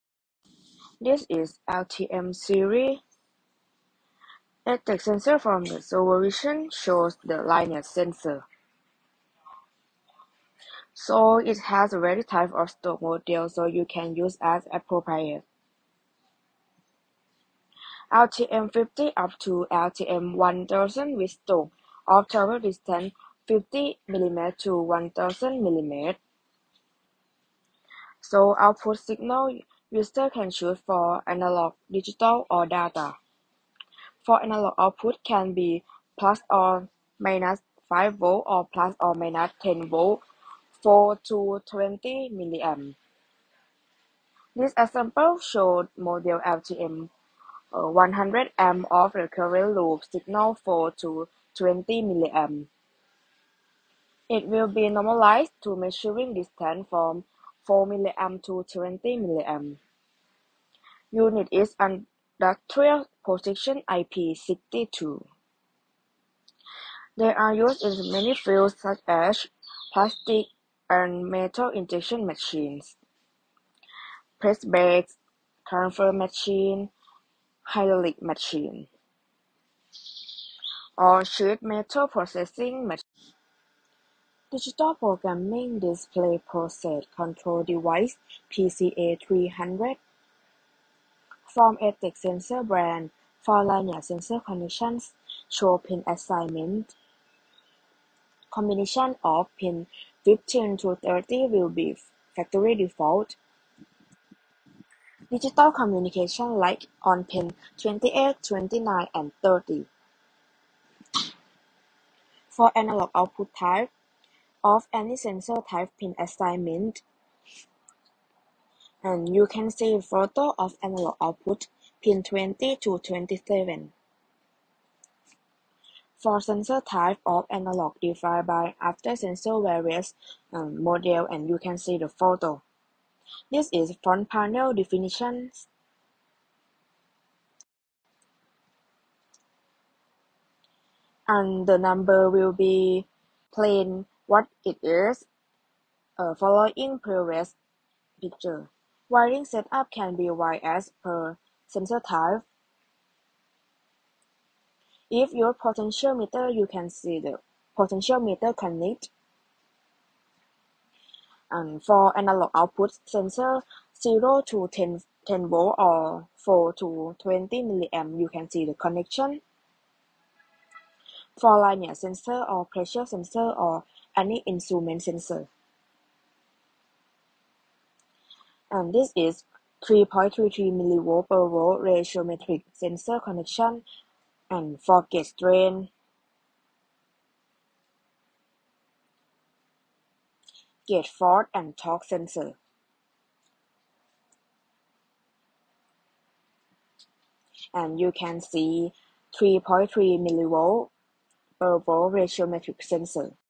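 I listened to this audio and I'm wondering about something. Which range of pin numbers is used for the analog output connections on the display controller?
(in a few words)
Pins 20 to 27.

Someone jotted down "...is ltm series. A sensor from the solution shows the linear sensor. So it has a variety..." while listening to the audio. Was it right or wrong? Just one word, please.
right.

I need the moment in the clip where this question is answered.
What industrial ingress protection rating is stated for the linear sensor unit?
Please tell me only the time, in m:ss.
1:03.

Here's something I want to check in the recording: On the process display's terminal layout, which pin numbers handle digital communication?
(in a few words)
28, 29 and 30.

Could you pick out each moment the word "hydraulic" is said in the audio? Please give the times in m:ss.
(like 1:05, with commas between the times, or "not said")
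1:17.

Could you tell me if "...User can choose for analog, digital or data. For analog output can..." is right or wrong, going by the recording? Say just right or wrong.
right.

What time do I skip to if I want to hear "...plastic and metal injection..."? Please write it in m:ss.
1:09.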